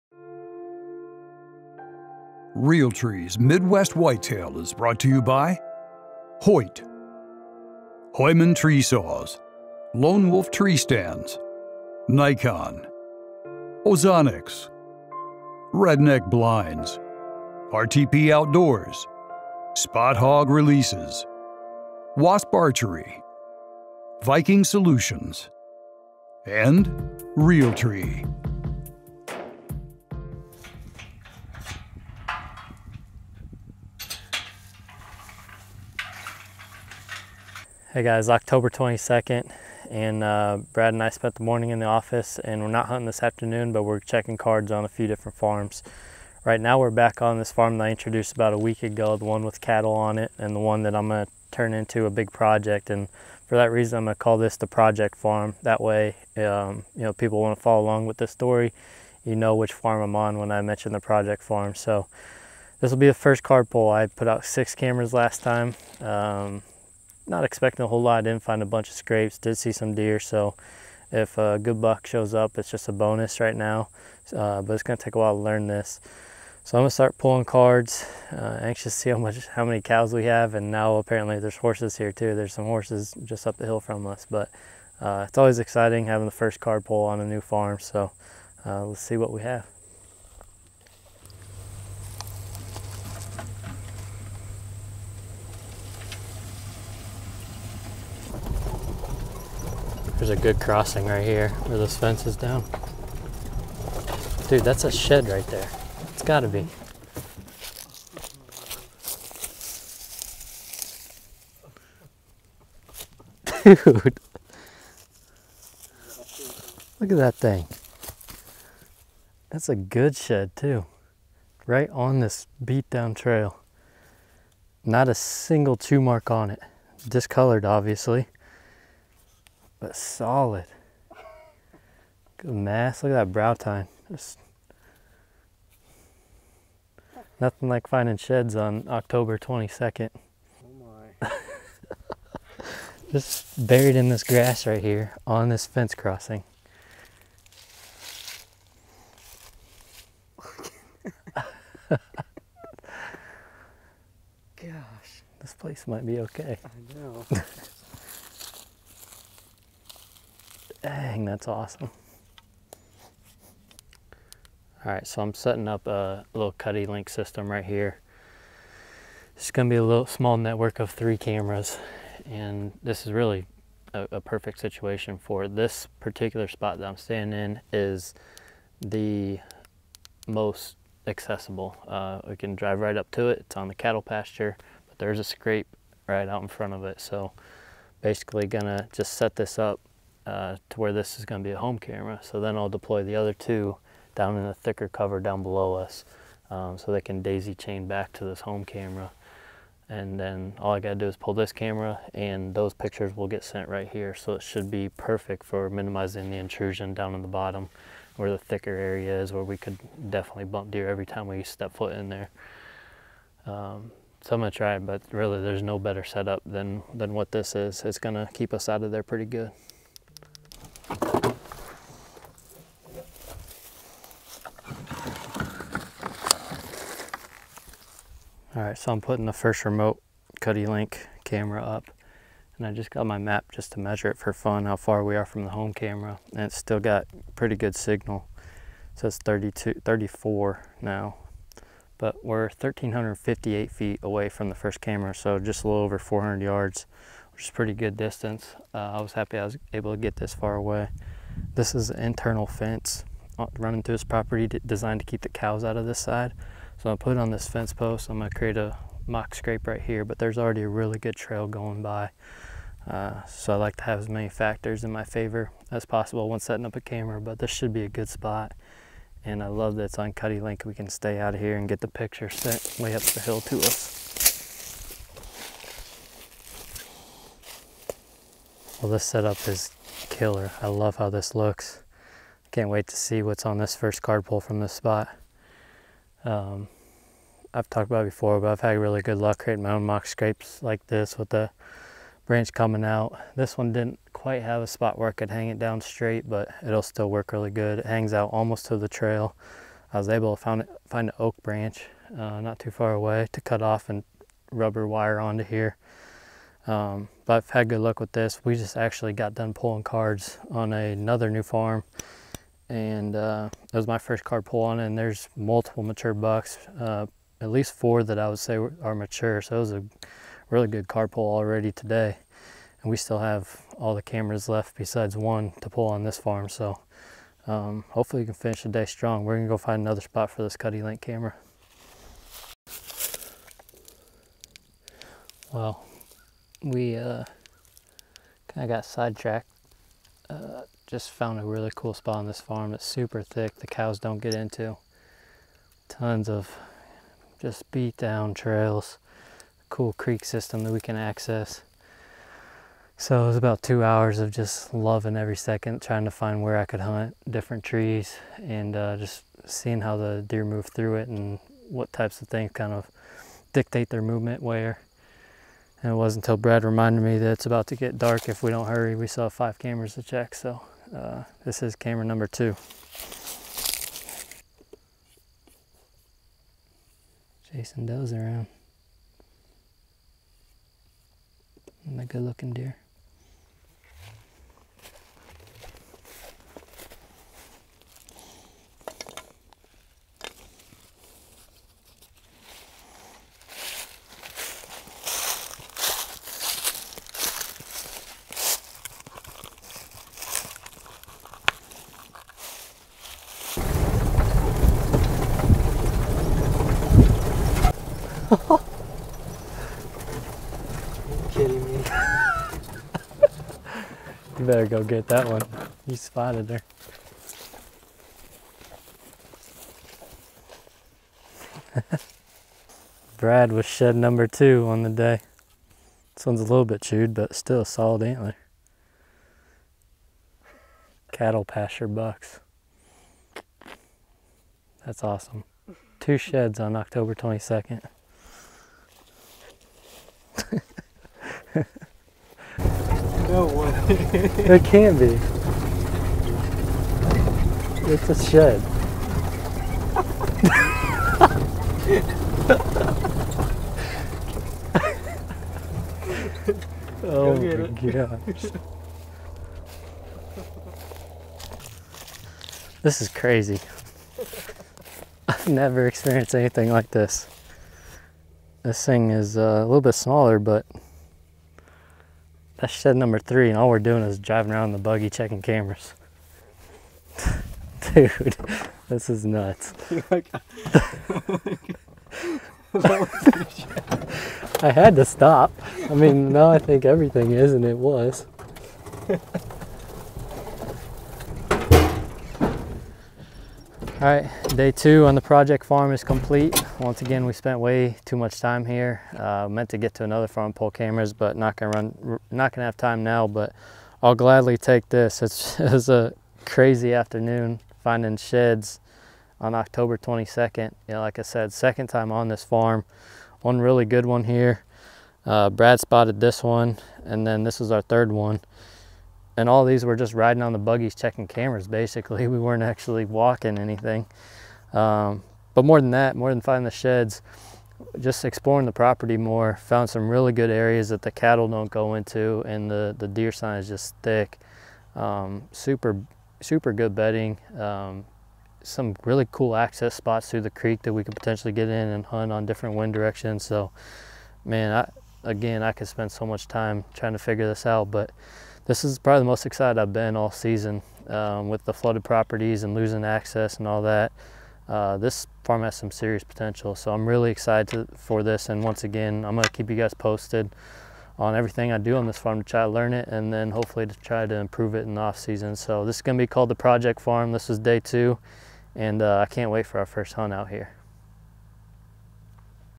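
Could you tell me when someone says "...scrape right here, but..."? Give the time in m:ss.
4:19.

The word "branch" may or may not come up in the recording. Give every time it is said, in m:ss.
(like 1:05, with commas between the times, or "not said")
4:52, 5:01.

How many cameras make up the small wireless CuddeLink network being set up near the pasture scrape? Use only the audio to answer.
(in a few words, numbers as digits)
3.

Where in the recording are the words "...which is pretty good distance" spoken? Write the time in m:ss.
4:07.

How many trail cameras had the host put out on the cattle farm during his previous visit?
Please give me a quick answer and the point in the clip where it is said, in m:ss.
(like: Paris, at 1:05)
6, at 1:04.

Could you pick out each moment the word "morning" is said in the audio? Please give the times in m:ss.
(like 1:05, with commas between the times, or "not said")
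0:41.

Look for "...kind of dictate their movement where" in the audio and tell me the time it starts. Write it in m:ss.
6:02.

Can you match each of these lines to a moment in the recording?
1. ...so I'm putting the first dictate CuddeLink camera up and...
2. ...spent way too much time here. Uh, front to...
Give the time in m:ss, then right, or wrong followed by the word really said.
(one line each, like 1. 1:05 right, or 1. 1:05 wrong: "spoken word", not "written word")
1. 3:48 wrong: "remote", not "dictate"
2. 8:17 wrong: "meant", not "front".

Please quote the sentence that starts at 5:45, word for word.
Tons of just beat down trails, cool creek system that we can access.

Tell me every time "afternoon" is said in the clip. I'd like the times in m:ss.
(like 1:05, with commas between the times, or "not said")
0:43, 8:26.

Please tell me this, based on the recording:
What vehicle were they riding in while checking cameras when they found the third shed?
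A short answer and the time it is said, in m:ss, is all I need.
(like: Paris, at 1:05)
the buggy, at 7:54.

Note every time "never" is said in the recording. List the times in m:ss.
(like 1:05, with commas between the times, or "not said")
7:45.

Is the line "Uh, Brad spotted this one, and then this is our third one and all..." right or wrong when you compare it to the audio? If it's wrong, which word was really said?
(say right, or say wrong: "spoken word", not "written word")
right.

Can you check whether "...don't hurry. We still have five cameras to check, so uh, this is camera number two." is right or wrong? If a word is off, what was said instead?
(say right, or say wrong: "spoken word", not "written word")
right.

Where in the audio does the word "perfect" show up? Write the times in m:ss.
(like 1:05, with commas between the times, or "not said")
2:54, 3:24.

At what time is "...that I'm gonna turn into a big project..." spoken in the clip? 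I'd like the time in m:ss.
0:50.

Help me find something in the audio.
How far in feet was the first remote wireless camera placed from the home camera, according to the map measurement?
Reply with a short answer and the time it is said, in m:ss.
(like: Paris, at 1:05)
1,358 feet, at 4:02.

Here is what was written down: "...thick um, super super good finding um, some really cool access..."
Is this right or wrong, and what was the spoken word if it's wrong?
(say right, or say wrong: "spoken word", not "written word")
wrong: "bedding", not "finding".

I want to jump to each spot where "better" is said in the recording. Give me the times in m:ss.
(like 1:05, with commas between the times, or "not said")
3:35, 6:54.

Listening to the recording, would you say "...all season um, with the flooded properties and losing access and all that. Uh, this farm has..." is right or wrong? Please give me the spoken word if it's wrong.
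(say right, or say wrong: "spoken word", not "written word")
right.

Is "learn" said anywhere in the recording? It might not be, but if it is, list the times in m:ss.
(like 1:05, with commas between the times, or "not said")
1:15, 9:22.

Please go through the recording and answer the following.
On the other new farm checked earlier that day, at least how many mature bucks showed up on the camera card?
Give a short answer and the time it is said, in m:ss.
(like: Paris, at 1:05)
4, at 5:17.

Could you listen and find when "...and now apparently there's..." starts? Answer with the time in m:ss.
1:20.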